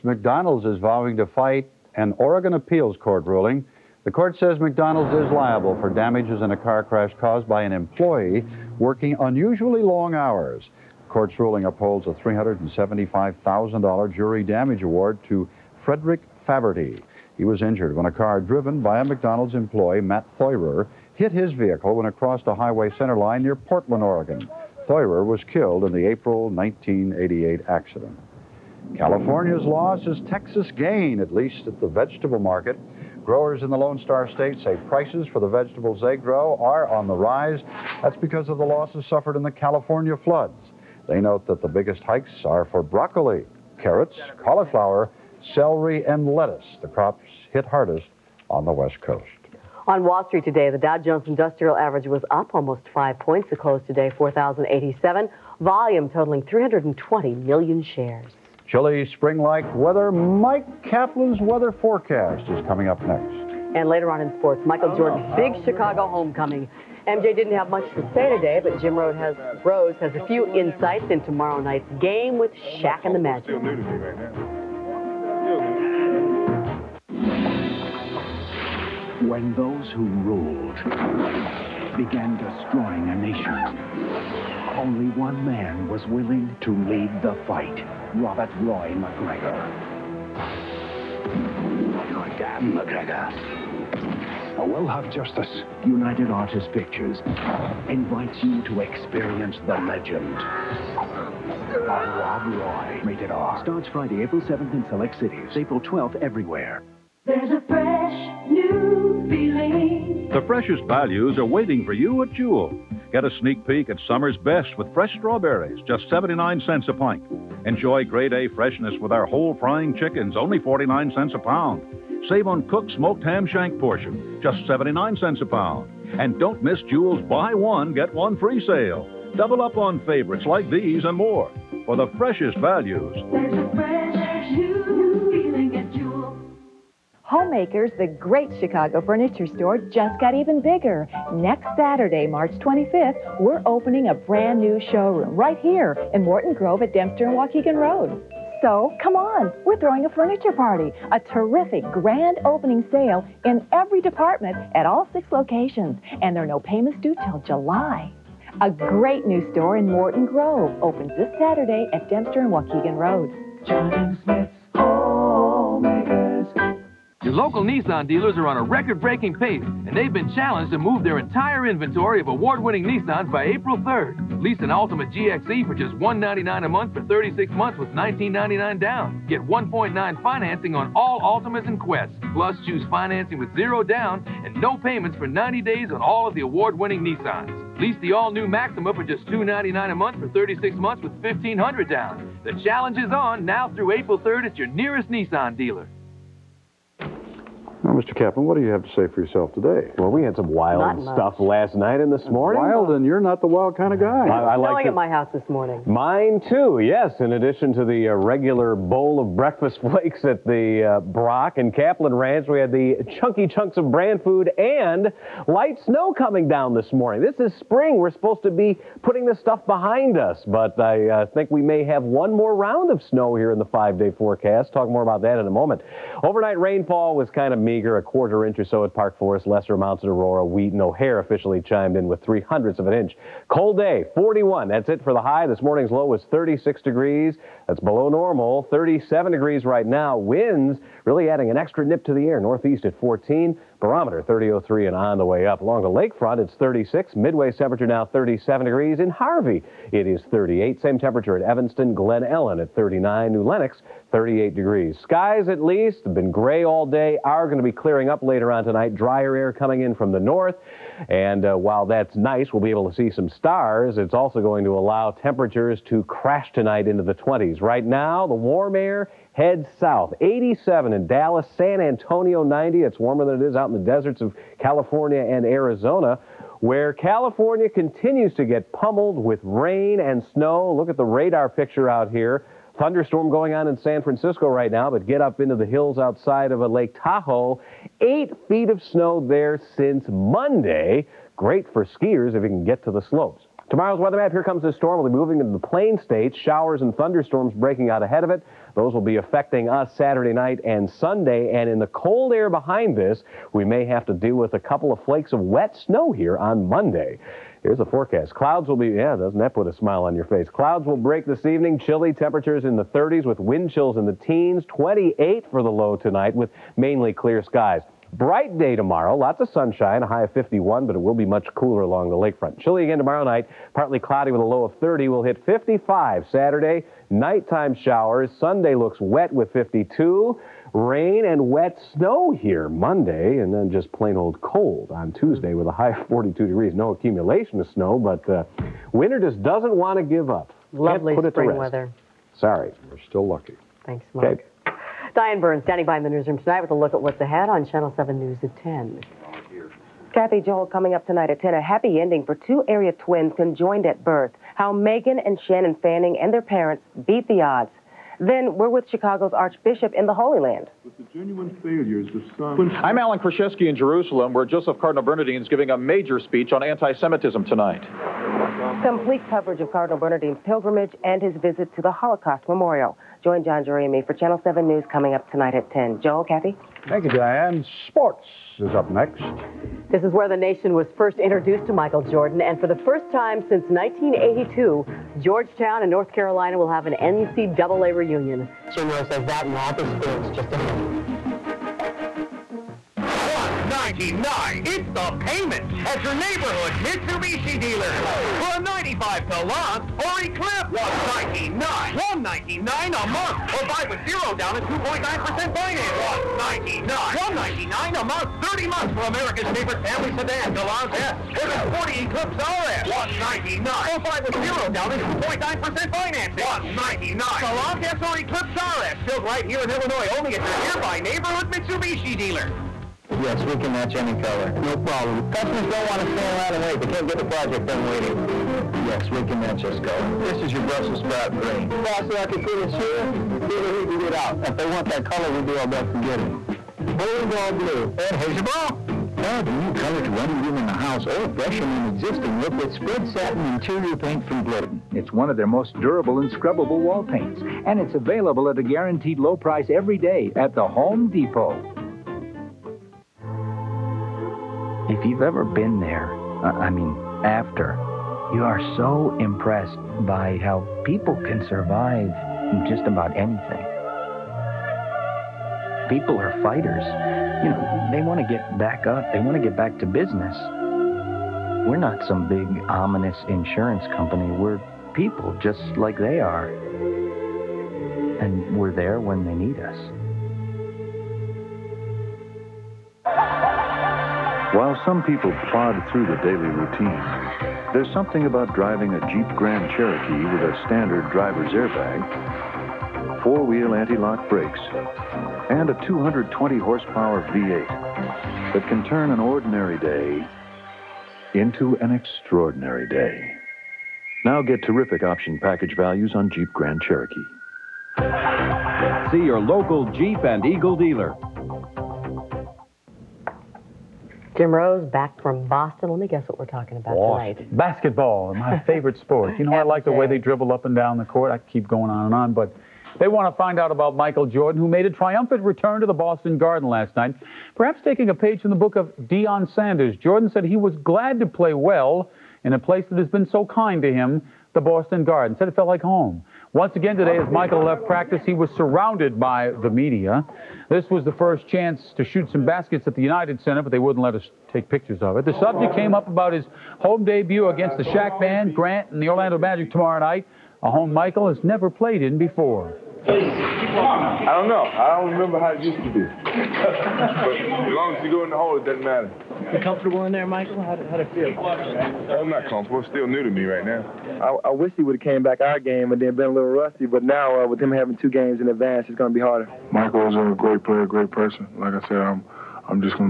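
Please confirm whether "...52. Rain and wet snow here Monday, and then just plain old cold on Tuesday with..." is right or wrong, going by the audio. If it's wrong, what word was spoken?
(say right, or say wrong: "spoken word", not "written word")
right.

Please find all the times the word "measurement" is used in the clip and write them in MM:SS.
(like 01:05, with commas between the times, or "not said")
not said.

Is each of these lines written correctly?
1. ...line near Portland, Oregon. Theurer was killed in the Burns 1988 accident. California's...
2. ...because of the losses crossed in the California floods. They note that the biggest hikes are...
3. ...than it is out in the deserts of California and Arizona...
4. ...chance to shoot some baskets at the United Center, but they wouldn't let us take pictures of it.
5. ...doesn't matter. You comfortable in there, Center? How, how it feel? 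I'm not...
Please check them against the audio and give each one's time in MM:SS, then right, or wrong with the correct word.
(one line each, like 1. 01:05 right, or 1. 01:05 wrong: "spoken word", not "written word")
1. 00:23 wrong: "April", not "Burns"
2. 00:38 wrong: "suffered", not "crossed"
3. 04:33 right
4. 09:01 right
5. 09:18 wrong: "Michael", not "Center".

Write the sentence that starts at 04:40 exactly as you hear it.
Look at the radar picture out here.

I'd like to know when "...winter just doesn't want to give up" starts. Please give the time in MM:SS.
05:38.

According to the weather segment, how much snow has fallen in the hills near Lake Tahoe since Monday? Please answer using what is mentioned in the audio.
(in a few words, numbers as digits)
Eight feet.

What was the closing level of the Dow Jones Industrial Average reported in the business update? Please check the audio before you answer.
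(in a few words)
4,087.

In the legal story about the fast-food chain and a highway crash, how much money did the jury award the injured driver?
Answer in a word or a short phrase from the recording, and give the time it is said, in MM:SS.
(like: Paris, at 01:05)
$375,000, at 00:12.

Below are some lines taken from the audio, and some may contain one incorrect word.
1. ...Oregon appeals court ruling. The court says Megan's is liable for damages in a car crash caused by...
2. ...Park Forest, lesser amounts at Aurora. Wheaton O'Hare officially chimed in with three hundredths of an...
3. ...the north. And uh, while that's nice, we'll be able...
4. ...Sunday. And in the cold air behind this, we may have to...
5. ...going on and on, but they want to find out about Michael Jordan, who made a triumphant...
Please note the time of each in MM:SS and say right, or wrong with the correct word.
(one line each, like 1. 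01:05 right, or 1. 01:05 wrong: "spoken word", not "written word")
1. 00:02 wrong: "McDonald", not "Megan"
2. 03:48 right
3. 04:20 right
4. 05:00 right
5. 08:41 right.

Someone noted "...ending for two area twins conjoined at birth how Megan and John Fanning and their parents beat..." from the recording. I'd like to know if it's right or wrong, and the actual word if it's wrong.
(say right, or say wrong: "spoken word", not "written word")
wrong: "Shannon", not "John".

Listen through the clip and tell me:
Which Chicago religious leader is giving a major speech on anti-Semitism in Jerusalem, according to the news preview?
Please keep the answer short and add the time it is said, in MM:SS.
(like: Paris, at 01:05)
Joseph Cardinal Bernardin, at 06:04.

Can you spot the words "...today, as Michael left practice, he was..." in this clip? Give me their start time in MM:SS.
08:56.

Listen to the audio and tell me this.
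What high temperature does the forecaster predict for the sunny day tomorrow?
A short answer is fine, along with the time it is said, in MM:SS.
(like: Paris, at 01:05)
51, at 05:20.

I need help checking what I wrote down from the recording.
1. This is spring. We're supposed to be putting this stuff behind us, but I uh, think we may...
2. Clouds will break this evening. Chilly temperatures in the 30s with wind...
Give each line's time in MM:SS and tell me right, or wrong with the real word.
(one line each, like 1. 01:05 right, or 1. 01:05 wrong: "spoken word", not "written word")
1. 03:37 right
2. 05:10 right.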